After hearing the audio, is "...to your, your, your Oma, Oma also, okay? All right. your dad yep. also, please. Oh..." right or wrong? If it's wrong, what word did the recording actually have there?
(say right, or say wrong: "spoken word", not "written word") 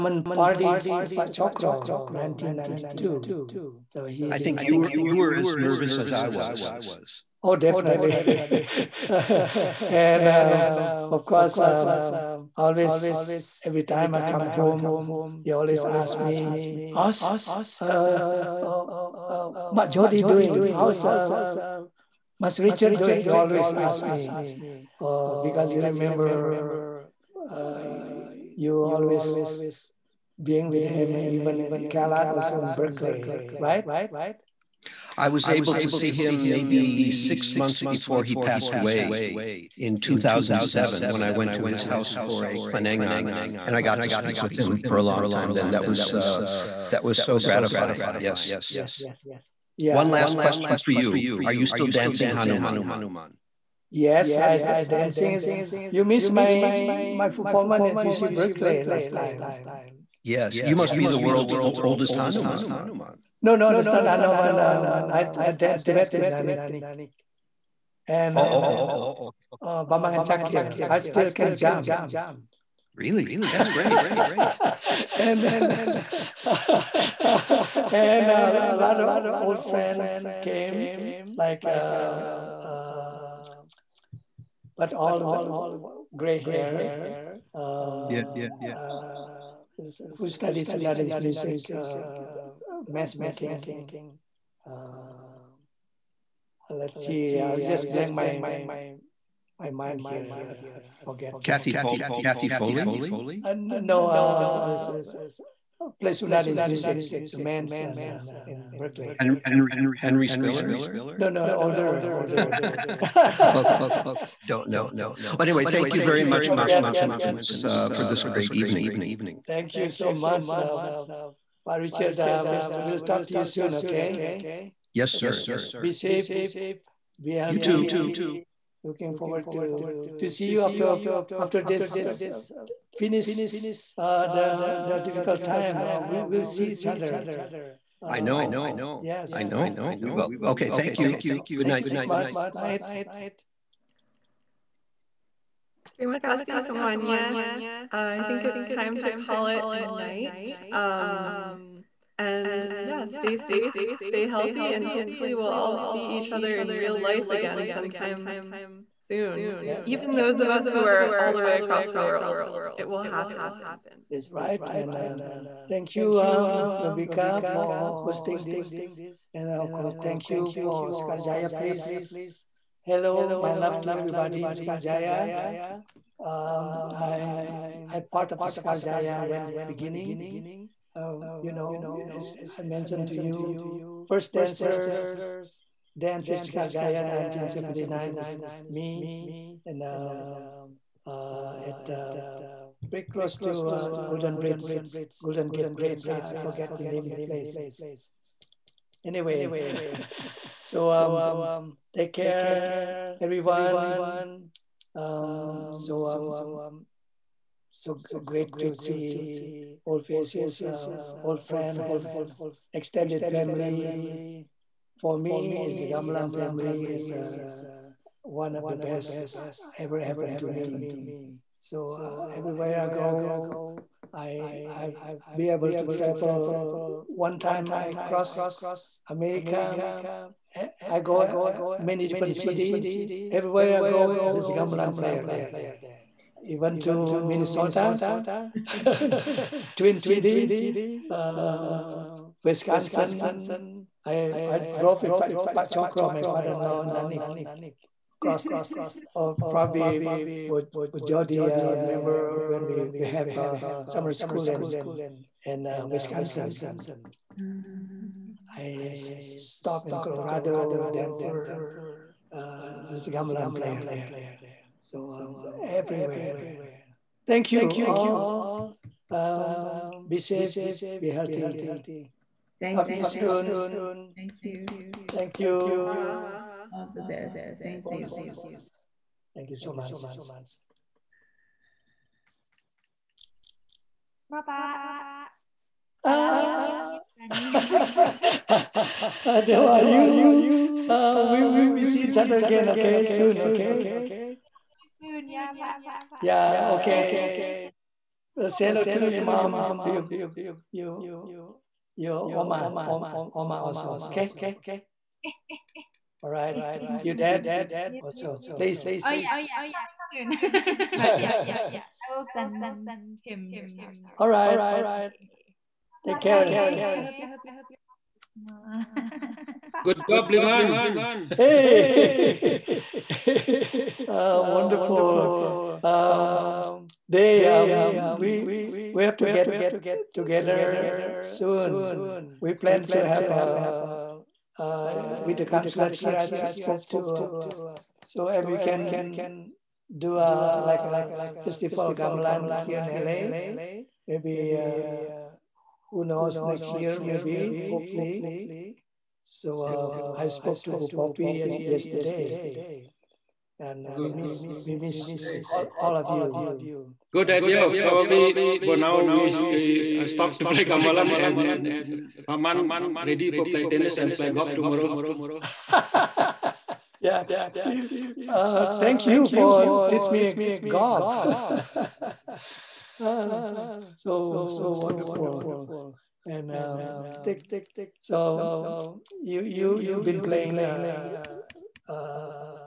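right.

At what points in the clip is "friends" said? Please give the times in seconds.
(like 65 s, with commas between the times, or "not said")
79 s, 211 s.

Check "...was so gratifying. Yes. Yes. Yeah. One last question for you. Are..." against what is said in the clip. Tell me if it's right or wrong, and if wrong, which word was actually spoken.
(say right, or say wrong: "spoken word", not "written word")
right.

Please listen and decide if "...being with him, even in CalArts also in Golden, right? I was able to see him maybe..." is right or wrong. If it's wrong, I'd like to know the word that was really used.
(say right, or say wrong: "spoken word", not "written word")
wrong: "Berkeley", not "Golden".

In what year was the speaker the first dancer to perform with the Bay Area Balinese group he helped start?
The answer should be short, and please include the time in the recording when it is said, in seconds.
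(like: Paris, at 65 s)
1979, at 187 s.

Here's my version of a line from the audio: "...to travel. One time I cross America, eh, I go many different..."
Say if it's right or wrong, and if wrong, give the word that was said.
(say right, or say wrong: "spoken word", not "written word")
right.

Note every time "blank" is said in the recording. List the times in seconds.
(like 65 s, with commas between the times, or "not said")
97 s.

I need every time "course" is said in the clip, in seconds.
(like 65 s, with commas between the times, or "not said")
11 s, 169 s.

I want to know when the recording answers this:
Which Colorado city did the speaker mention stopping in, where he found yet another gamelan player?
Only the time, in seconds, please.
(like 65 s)
260 s.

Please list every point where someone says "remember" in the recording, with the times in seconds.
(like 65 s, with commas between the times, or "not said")
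25 s.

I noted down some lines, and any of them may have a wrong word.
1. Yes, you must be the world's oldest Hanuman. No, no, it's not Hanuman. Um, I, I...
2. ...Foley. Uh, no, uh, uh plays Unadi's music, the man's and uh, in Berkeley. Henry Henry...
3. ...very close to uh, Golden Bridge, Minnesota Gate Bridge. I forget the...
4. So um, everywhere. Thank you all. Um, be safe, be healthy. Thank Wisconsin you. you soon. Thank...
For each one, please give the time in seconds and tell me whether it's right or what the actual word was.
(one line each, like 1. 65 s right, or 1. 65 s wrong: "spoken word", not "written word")
1. 60 s right
2. 102 s right
3. 192 s wrong: "Golden", not "Minnesota"
4. 264 s wrong: "Talk", not "Wisconsin".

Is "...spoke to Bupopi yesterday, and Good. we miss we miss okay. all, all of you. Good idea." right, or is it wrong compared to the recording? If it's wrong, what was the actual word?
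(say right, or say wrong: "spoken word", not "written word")
right.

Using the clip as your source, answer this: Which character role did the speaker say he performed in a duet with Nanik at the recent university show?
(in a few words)
Bambang Chakil.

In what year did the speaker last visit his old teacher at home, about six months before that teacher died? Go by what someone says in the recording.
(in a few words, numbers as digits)
2007.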